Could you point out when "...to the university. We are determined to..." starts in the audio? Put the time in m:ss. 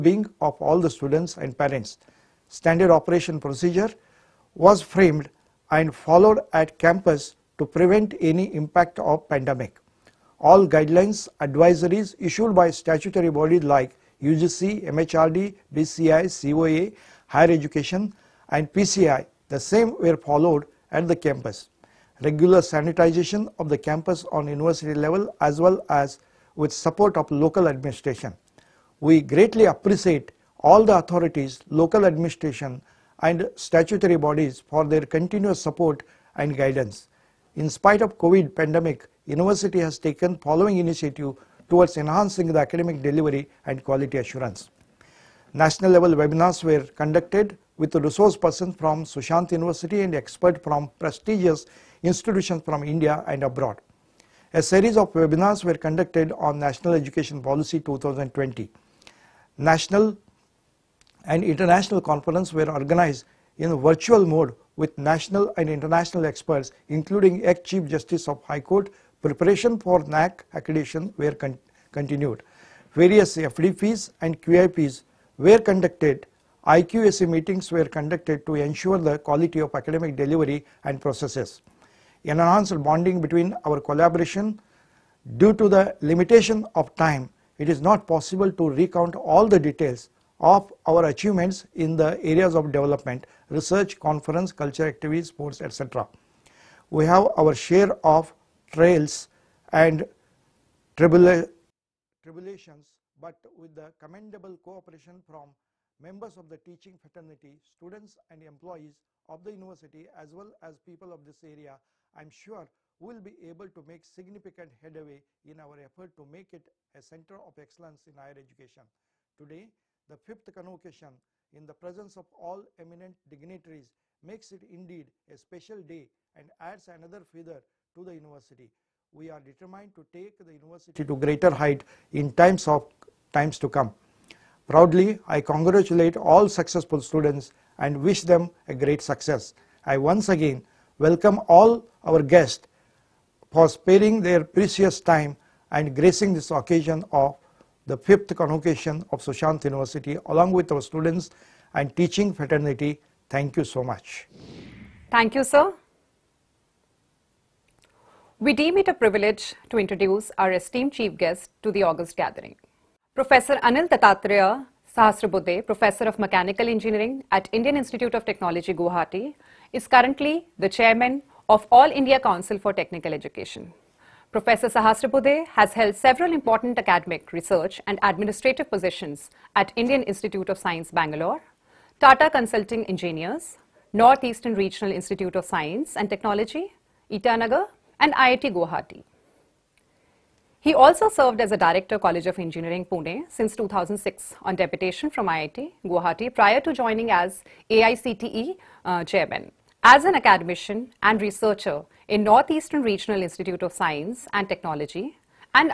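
2:07.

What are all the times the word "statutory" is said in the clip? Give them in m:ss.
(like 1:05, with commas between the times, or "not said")
0:12, 0:33.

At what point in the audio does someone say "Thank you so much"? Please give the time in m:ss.
2:33.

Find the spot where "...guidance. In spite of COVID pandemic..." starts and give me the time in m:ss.
0:36.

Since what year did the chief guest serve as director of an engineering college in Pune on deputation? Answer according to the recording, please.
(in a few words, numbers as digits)
2006.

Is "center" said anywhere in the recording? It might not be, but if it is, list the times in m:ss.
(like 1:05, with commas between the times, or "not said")
1:57.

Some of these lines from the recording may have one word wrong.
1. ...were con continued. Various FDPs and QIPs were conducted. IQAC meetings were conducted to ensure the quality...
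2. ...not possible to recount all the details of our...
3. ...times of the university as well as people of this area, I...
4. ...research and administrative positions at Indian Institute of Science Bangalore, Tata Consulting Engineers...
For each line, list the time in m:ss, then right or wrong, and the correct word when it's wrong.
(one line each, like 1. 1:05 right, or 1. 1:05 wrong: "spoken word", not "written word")
1. 1:11 right
2. 1:27 right
3. 1:48 wrong: "employees", not "times"
4. 2:57 right.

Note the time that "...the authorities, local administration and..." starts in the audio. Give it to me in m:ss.
0:30.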